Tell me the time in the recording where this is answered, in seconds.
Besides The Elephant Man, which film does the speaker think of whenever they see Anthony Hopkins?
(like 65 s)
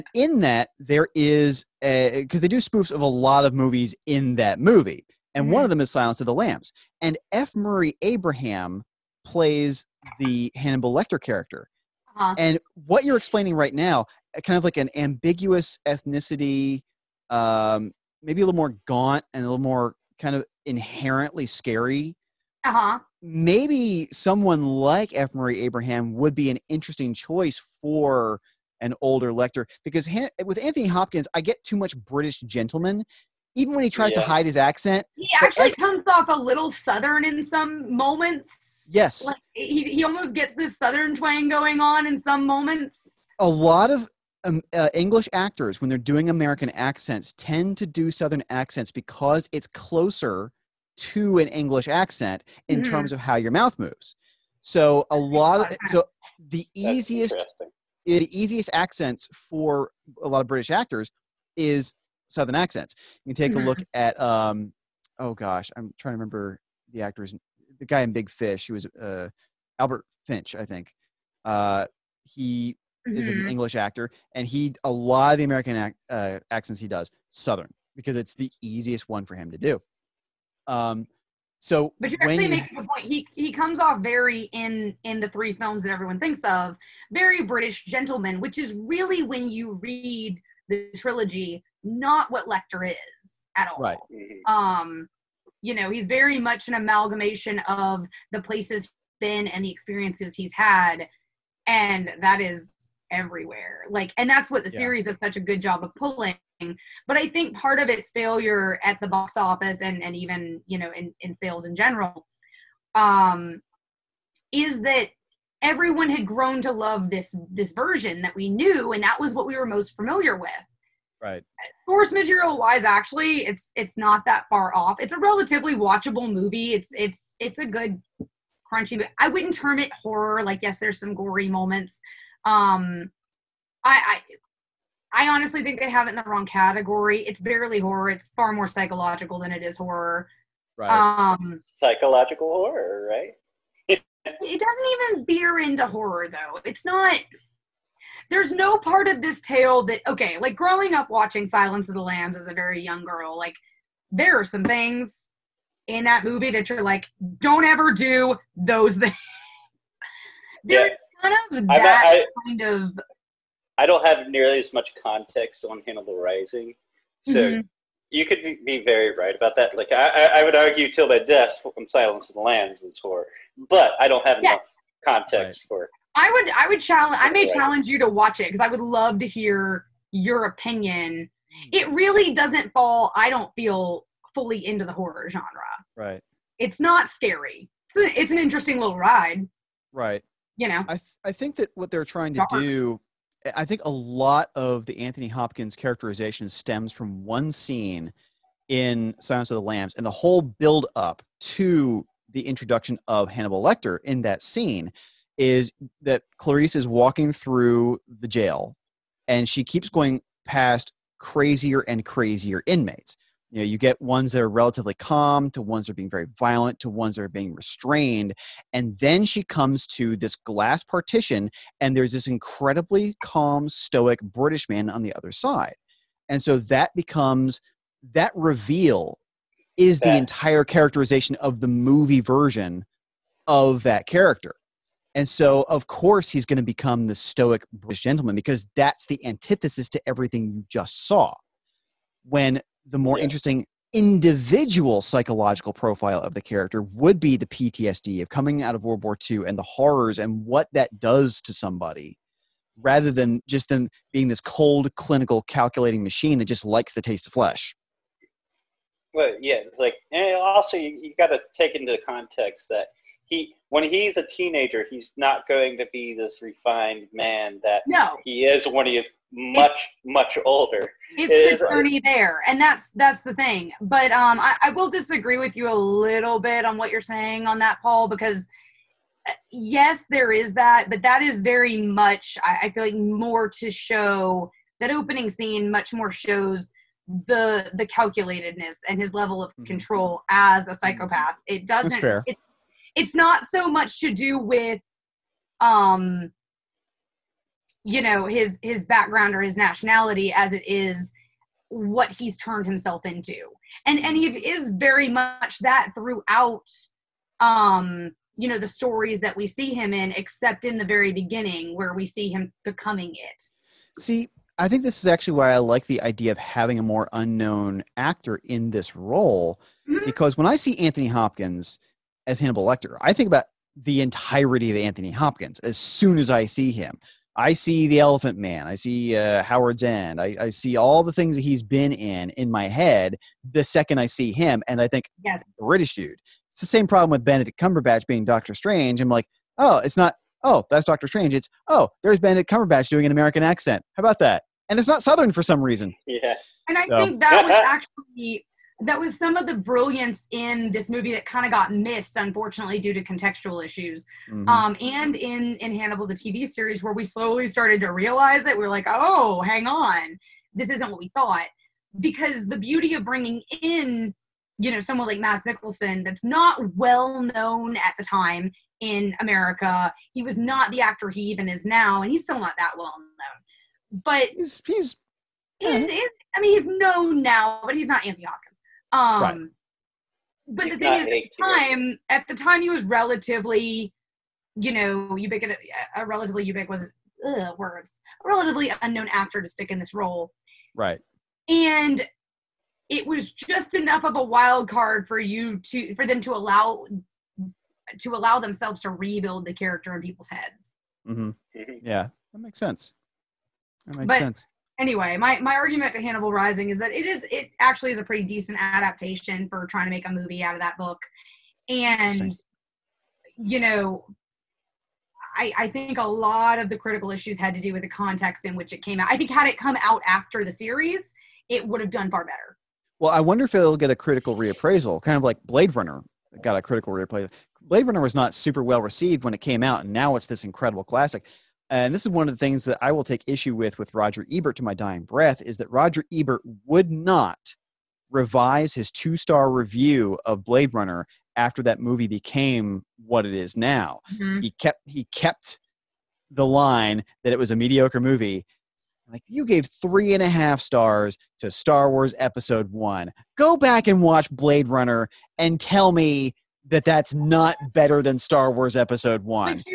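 329 s.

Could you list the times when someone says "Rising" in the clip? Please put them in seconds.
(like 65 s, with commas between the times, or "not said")
166 s, 406 s.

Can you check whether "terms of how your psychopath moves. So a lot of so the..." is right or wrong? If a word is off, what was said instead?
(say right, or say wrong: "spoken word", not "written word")
wrong: "mouth", not "psychopath".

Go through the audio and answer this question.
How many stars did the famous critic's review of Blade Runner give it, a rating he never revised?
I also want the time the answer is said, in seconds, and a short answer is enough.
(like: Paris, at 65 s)
2, at 438 s.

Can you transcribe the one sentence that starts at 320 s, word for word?
because when i see anthony hopkins as Hannibal Lecter.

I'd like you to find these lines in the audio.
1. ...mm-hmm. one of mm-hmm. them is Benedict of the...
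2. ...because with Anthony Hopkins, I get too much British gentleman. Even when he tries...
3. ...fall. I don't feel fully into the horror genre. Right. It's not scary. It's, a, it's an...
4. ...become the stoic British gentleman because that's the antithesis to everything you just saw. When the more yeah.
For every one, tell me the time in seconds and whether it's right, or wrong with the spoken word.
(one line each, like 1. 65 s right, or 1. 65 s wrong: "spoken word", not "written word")
1. 5 s wrong: "Silence", not "Benedict"
2. 29 s right
3. 182 s right
4. 236 s right.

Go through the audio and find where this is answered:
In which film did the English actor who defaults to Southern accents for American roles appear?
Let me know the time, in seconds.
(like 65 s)
68 s.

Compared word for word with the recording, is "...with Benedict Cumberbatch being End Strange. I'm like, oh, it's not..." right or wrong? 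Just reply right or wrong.
wrong.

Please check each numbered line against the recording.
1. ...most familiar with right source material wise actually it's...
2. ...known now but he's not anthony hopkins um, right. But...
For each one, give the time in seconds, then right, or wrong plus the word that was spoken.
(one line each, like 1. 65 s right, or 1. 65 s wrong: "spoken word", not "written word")
1. 119 s right
2. 376 s right.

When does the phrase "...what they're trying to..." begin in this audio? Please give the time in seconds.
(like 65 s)
191 s.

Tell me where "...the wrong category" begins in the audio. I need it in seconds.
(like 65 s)
136 s.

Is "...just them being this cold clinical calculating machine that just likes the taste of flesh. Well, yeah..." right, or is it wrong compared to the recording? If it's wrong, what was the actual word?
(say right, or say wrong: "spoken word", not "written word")
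right.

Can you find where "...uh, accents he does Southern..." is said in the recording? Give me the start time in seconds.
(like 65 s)
76 s.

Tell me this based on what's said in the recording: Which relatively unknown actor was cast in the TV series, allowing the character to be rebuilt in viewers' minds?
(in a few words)
Mads Mikkelsen.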